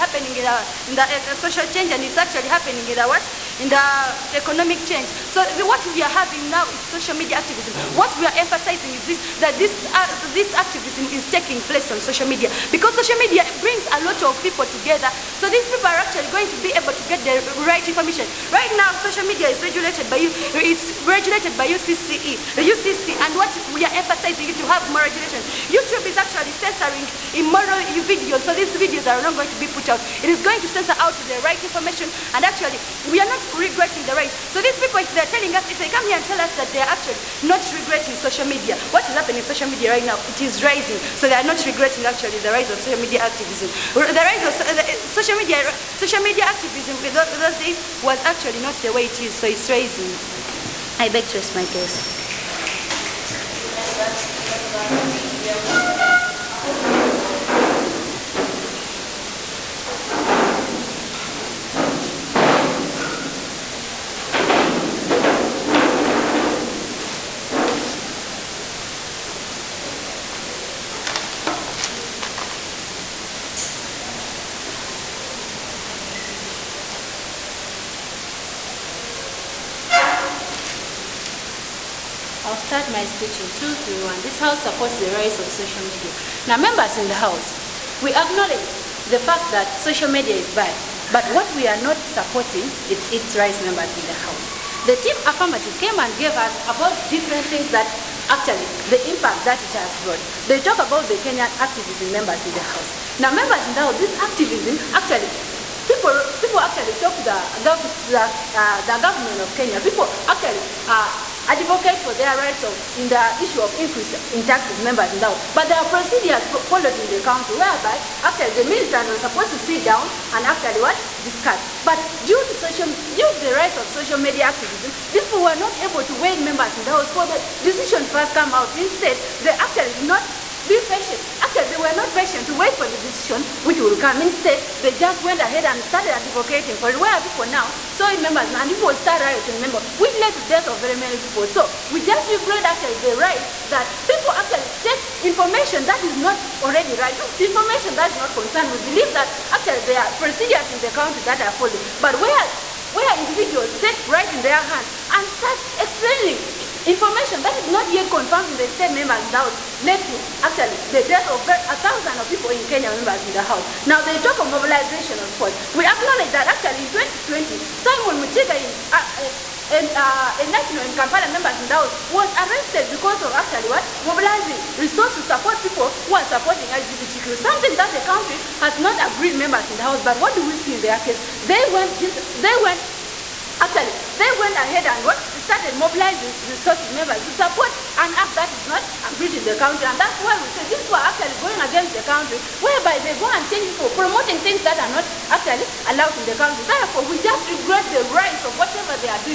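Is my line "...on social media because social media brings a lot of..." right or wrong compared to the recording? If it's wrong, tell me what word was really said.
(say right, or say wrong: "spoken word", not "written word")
right.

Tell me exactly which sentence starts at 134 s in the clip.
Instead, they just went ahead and started advocating for it.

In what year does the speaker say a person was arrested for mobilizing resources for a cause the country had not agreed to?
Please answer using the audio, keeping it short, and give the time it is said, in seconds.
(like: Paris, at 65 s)
2020, at 166 s.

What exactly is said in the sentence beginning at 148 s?
We believe that actually there are procedures in the country that are followed.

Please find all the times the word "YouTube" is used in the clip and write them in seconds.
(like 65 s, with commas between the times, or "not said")
25 s.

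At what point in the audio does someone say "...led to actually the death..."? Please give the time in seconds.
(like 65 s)
159 s.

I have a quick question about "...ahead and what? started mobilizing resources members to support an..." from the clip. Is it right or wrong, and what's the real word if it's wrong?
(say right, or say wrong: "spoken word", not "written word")
right.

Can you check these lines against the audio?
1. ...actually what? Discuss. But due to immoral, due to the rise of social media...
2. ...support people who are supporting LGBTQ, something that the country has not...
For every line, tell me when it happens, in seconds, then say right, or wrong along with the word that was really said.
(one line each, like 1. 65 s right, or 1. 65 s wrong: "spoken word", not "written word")
1. 120 s wrong: "social", not "immoral"
2. 175 s right.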